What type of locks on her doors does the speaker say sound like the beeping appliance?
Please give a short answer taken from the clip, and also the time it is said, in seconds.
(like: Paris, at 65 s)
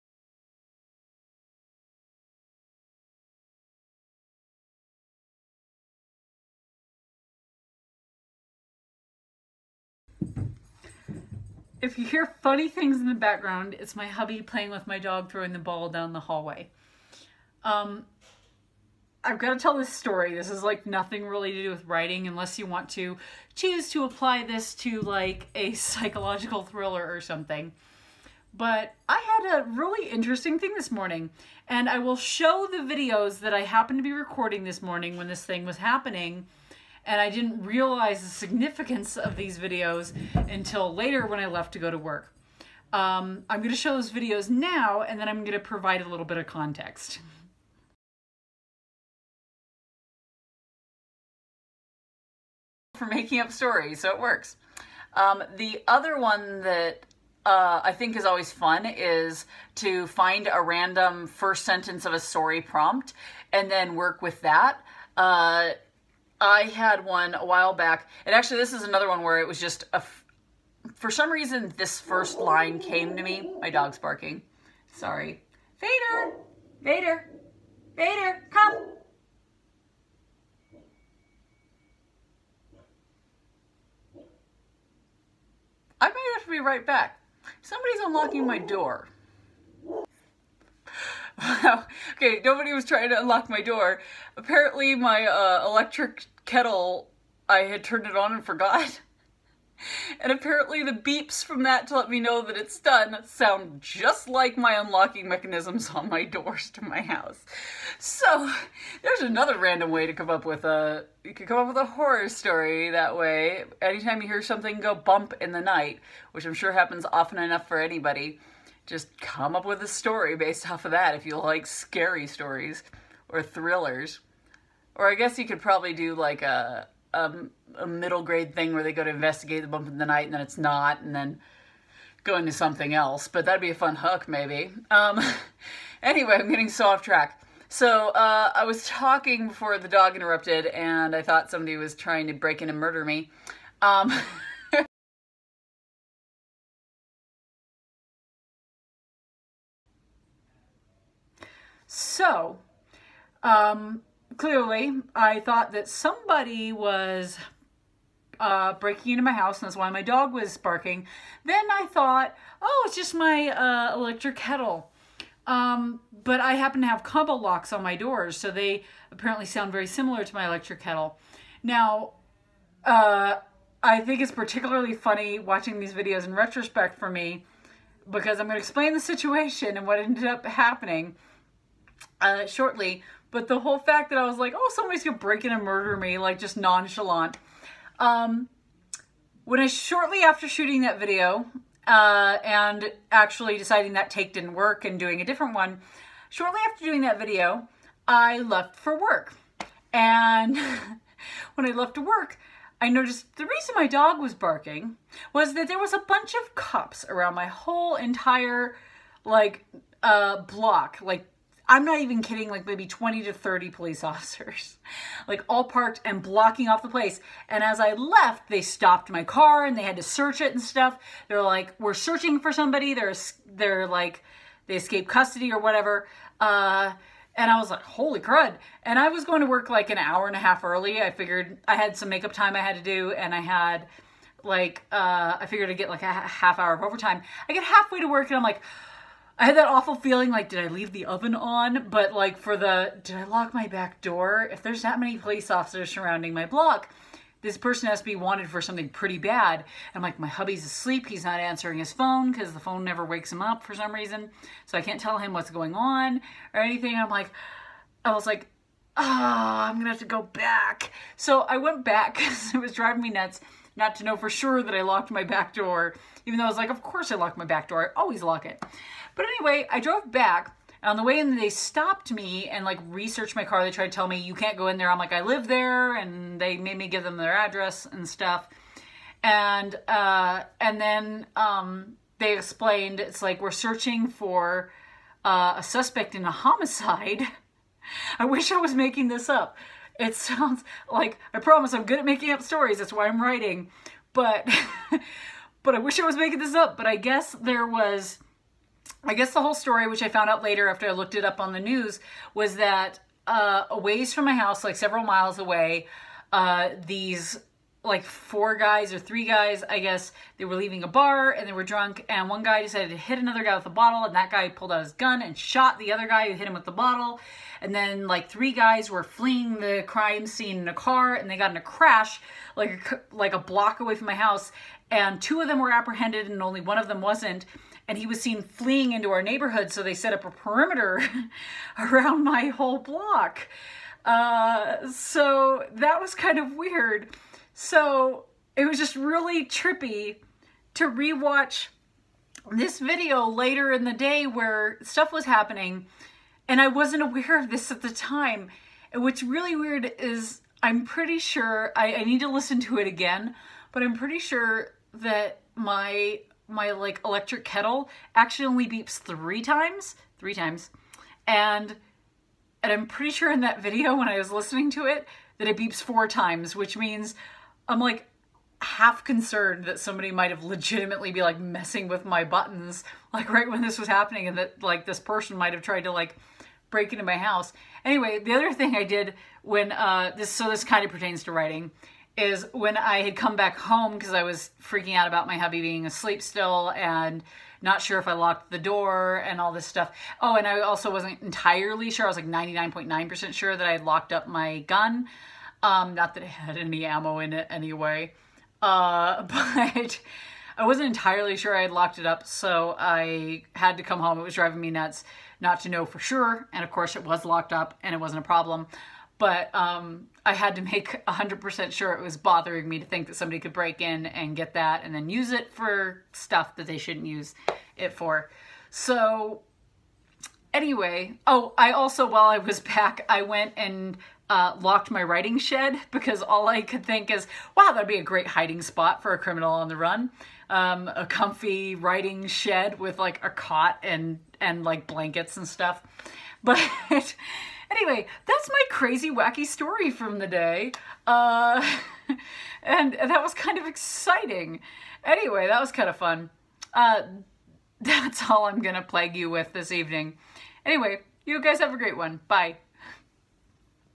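combo locks, at 167 s.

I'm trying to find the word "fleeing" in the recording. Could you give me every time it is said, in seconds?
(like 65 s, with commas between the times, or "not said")
319 s, 328 s.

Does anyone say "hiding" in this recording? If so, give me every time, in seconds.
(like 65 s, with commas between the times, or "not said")
428 s.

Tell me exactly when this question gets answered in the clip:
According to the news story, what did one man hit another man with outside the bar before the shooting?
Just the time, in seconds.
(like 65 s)
313 s.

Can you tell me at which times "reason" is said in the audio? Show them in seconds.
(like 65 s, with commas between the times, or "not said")
71 s, 203 s, 253 s.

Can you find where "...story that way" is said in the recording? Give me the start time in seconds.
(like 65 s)
112 s.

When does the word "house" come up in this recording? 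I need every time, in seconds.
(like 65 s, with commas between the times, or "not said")
107 s, 159 s, 304 s, 324 s, 377 s.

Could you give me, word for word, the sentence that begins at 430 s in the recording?
Um, a comfy writing shed with like a cot and, and like blankets and stuff.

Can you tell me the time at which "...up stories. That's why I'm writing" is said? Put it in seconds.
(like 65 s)
292 s.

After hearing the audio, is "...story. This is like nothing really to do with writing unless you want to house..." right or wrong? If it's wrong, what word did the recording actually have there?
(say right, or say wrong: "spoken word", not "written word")
wrong: "choose", not "house".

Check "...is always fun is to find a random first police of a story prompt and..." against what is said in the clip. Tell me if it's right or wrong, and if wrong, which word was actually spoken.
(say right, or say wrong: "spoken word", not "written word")
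wrong: "sentence", not "police".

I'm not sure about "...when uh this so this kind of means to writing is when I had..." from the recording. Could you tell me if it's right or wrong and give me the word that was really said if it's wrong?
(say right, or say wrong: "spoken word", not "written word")
wrong: "pertains", not "means".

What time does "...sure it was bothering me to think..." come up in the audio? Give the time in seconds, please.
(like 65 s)
411 s.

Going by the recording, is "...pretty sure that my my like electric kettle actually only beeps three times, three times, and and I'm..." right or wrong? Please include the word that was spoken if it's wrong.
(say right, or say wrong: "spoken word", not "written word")
right.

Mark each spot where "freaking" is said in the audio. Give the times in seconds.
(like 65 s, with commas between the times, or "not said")
384 s.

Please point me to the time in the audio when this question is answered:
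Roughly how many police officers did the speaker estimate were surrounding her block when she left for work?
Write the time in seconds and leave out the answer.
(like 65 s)
212 s.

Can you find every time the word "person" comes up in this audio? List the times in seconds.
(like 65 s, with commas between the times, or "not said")
247 s, 374 s.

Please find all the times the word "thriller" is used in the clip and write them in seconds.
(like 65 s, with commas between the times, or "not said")
26 s, 123 s.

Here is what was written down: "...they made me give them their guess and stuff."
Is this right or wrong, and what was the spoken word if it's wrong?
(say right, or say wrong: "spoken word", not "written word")
wrong: "address", not "guess".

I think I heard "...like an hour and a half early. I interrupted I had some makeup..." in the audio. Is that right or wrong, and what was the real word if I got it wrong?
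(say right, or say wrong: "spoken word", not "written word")
wrong: "figured", not "interrupted".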